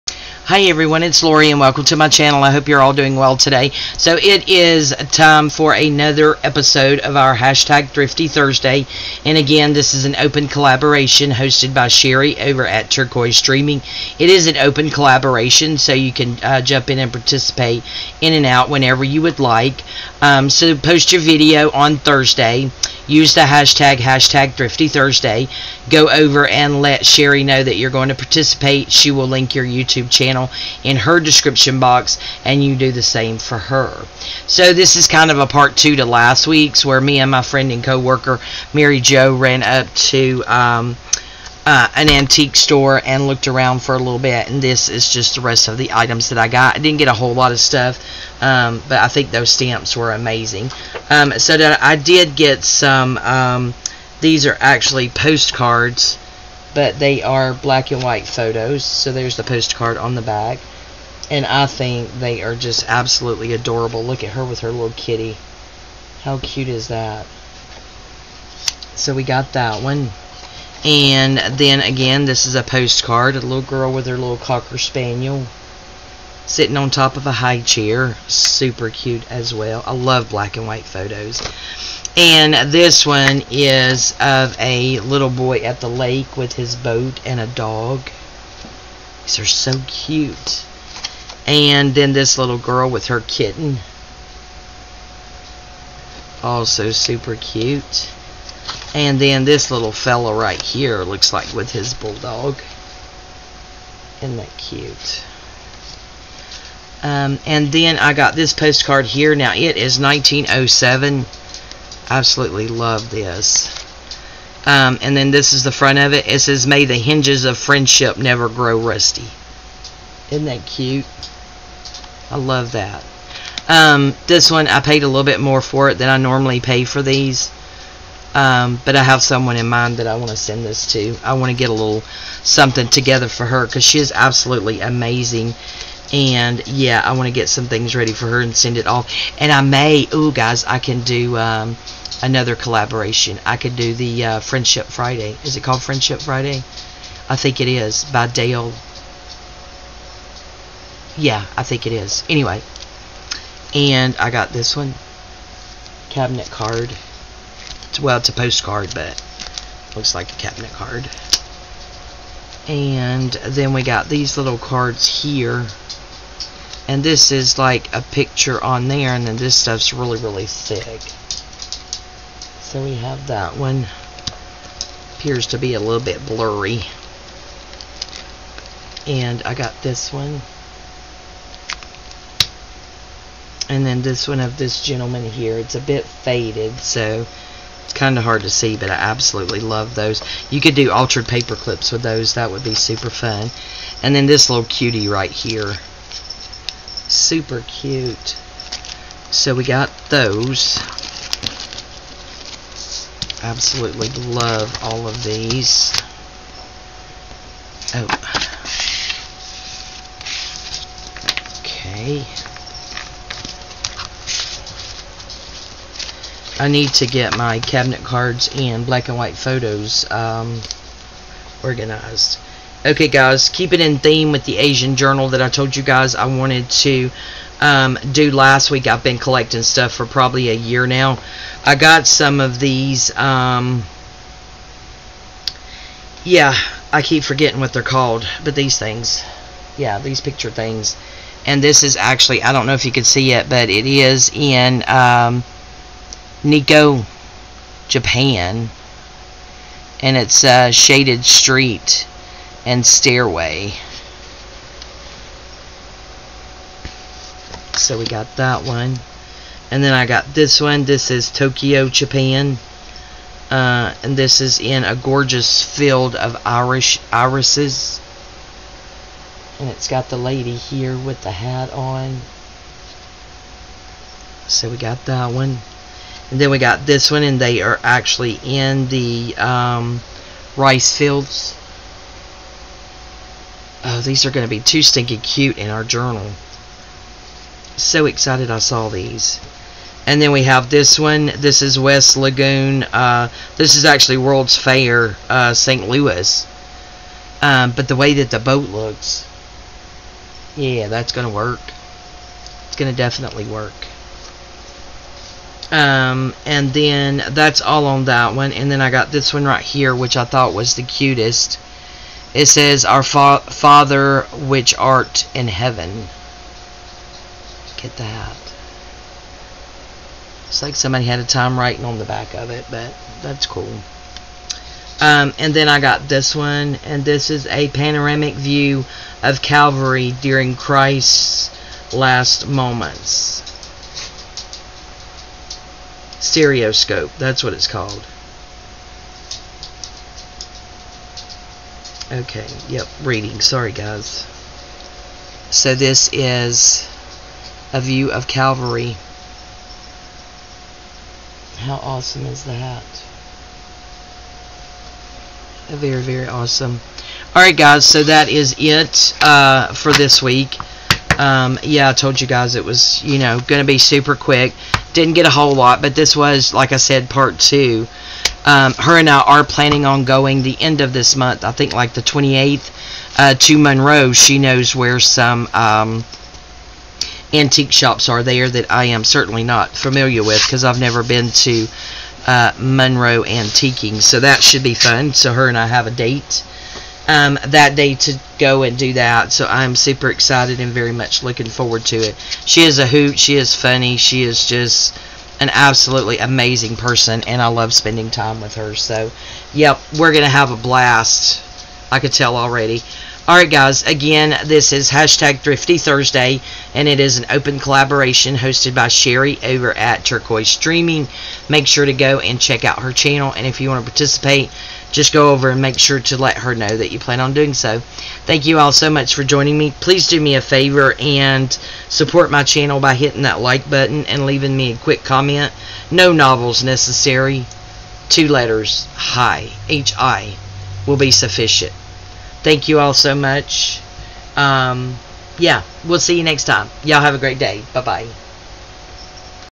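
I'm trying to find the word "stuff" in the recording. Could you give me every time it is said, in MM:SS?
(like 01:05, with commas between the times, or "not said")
00:47, 02:49, 03:49.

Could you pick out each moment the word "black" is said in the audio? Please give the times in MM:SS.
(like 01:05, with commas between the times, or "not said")
00:57, 01:20, 03:38.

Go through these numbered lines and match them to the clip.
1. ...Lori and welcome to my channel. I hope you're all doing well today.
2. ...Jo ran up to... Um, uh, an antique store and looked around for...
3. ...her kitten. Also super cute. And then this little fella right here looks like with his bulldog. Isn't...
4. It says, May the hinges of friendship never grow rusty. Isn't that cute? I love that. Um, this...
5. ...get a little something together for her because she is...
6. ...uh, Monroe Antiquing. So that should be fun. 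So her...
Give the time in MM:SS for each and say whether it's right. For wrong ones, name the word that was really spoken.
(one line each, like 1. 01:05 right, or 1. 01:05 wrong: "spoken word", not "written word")
1. 00:01 right
2. 00:39 right
3. 01:33 right
4. 01:56 right
5. 02:11 right
6. 06:22 right.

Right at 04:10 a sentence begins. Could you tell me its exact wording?
And it's a shaded street and stairway.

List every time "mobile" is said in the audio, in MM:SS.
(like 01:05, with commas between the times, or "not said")
not said.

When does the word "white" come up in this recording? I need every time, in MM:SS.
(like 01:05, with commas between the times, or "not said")
00:58, 01:20, 03:39.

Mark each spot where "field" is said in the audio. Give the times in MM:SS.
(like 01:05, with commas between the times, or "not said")
04:25, 04:40.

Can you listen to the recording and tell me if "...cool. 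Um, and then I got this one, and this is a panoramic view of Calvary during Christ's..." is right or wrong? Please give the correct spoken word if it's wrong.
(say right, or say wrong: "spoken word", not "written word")
right.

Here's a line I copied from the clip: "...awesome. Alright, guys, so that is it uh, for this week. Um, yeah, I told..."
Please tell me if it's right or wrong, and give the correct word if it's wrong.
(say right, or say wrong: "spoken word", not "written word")
right.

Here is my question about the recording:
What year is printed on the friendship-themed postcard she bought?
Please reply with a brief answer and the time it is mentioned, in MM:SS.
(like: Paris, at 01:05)
1907, at 01:49.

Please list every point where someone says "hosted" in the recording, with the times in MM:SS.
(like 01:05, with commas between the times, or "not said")
00:11, 06:48.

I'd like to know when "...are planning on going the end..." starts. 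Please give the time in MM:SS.
06:09.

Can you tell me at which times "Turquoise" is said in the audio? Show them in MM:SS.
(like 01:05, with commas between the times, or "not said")
00:12, 06:50.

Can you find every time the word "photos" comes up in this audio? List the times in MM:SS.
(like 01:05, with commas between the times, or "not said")
00:58, 01:20, 03:39.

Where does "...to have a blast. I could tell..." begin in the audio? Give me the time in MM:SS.
06:40.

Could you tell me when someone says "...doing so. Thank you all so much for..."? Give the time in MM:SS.
06:57.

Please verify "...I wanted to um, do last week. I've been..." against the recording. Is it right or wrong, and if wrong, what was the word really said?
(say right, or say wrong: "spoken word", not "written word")
right.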